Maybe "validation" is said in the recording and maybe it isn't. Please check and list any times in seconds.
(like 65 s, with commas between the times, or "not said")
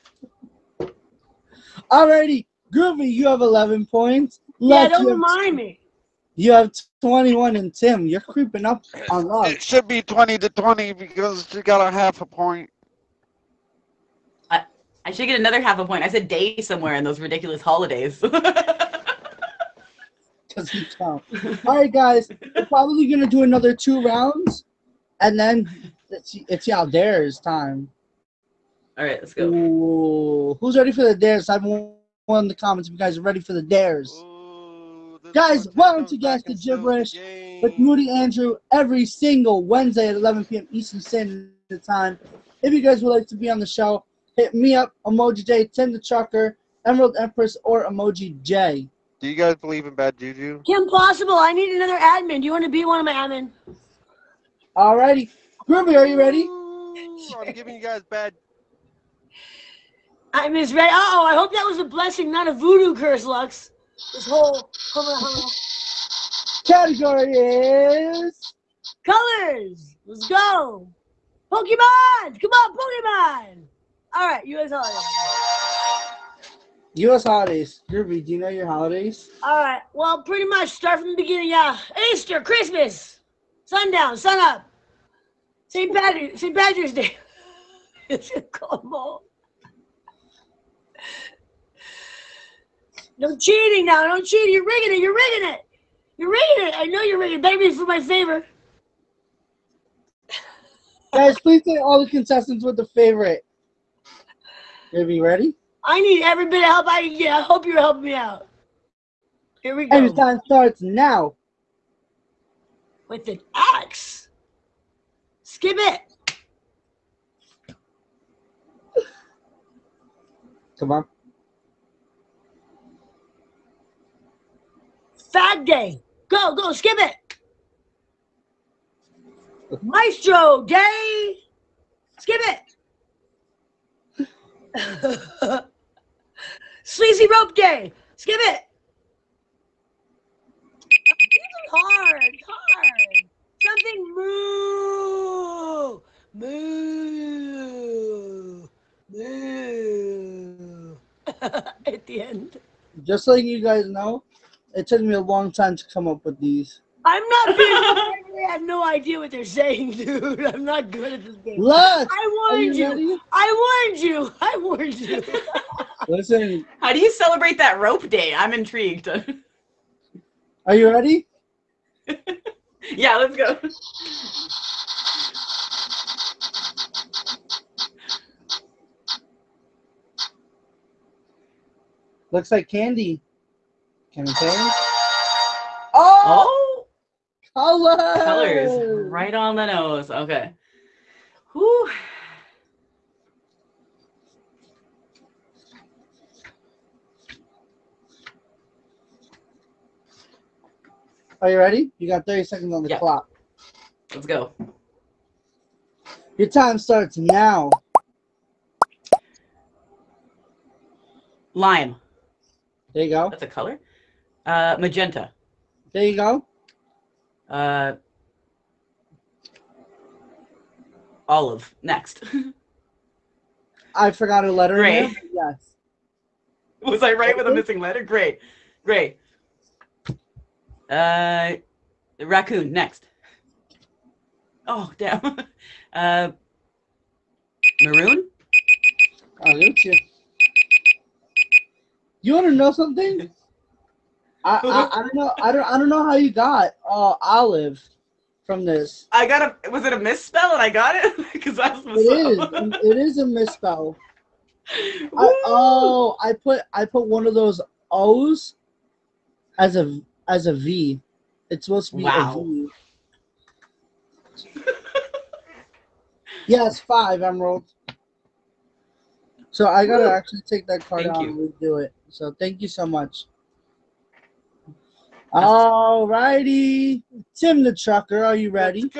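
not said.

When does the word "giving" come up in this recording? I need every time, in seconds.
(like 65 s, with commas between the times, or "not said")
57 s.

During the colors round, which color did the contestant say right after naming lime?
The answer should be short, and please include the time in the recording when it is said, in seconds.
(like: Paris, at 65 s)
Magenta, at 214 s.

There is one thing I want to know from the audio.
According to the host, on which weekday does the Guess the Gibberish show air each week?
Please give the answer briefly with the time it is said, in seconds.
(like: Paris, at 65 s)
Wednesday, at 39 s.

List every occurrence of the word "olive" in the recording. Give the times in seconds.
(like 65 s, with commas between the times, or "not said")
221 s, 247 s.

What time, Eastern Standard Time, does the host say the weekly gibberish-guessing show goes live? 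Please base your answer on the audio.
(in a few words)
11 p.m.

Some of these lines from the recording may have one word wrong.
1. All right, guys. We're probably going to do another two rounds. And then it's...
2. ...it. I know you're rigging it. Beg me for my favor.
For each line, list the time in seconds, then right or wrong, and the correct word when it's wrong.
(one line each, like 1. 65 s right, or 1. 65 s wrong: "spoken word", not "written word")
1. 21 s right
2. 96 s right.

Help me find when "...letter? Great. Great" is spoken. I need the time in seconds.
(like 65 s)
227 s.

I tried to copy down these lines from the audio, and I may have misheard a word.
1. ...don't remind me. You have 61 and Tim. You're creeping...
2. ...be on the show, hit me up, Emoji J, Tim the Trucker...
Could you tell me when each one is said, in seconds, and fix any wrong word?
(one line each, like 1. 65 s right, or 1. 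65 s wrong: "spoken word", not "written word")
1. 4 s wrong: "21", not "61"
2. 43 s right.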